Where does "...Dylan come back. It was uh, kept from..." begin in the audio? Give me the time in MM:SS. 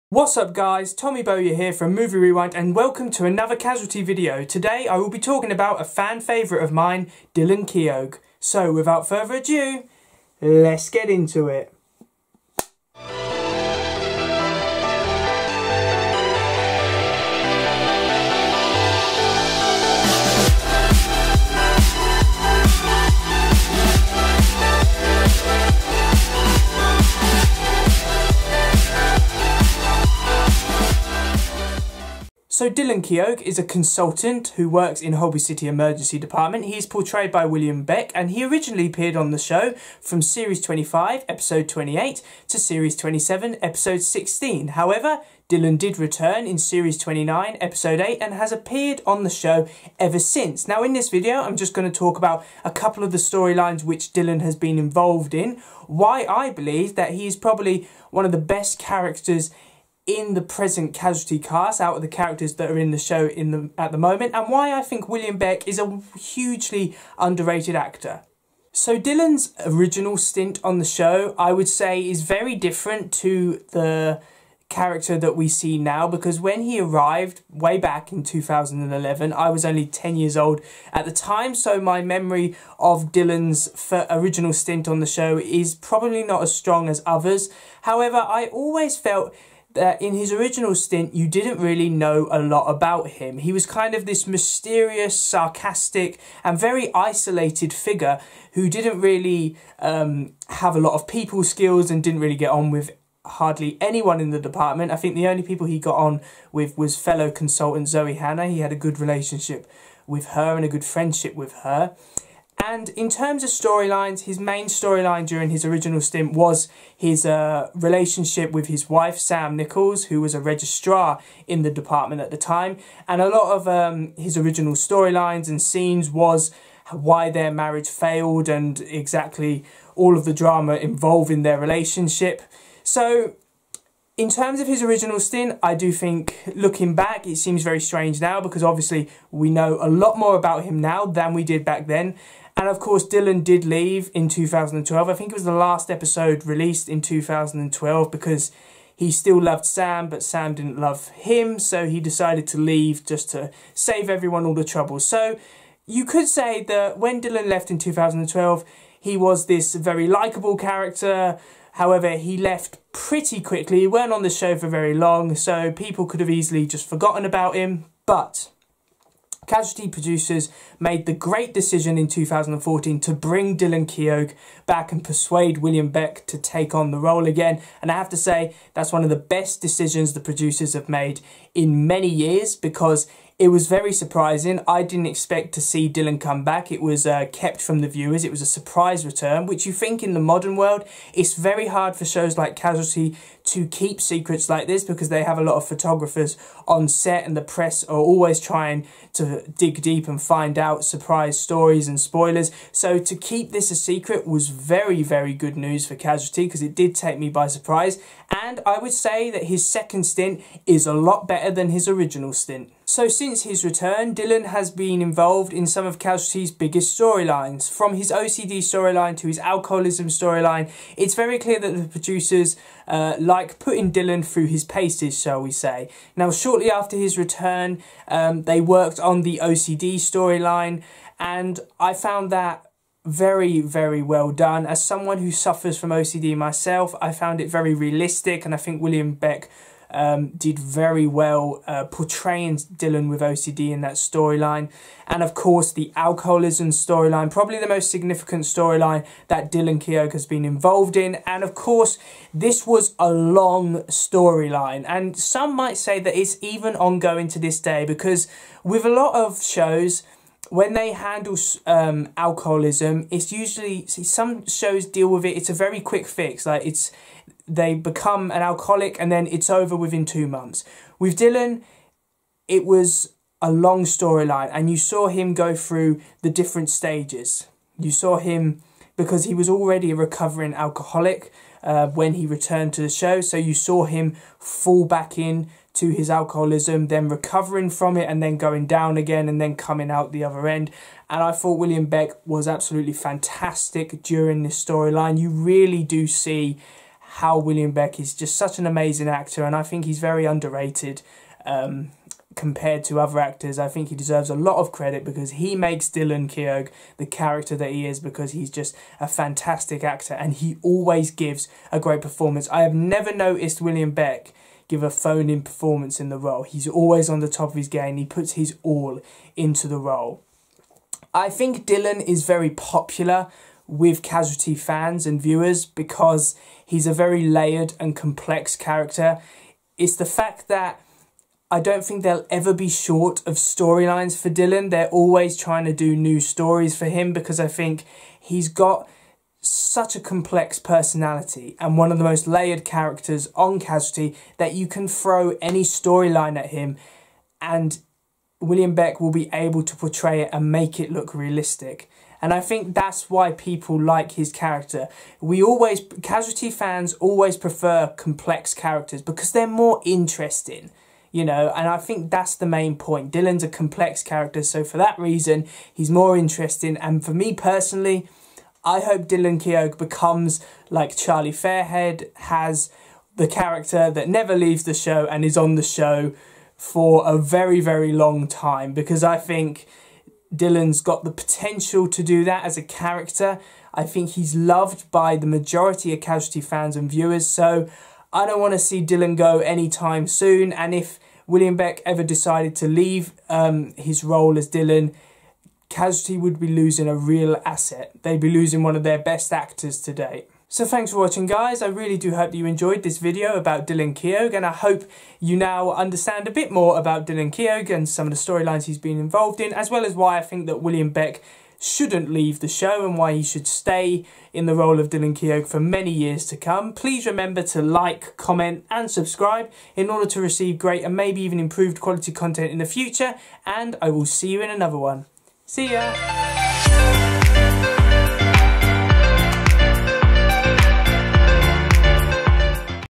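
03:05.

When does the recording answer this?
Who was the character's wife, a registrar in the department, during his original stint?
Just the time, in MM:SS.
01:59.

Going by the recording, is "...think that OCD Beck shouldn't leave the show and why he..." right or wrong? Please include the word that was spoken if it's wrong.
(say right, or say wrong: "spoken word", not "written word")
wrong: "William", not "OCD".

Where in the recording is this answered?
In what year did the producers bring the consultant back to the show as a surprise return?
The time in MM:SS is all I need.
02:52.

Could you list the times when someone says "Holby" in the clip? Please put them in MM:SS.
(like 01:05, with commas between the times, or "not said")
00:35.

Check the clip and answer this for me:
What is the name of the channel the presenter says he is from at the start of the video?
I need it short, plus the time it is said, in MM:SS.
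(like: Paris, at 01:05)
Movie Rewind, at 00:01.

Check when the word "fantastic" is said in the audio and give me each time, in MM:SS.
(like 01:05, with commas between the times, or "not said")
04:52, 05:09.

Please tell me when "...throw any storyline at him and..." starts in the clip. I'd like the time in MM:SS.
05:44.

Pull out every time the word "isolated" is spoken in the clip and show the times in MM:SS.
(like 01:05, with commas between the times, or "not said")
01:36.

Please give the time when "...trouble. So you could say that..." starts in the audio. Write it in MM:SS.
02:34.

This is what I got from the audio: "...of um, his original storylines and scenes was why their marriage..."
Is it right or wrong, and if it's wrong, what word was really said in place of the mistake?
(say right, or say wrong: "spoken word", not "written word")
right.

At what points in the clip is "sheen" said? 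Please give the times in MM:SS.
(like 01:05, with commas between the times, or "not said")
not said.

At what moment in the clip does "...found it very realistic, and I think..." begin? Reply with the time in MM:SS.
03:57.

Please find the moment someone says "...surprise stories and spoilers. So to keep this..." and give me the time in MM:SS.
03:20.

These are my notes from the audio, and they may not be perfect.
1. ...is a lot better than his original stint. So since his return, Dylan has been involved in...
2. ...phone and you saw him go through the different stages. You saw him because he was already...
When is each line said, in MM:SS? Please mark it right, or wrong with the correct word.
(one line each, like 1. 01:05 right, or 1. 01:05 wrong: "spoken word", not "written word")
1. 03:30 right
2. 04:33 wrong: "storyline", not "phone".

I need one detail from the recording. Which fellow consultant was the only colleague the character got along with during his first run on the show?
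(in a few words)
Zoe Hanna.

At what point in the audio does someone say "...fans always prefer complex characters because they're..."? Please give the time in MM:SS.
05:56.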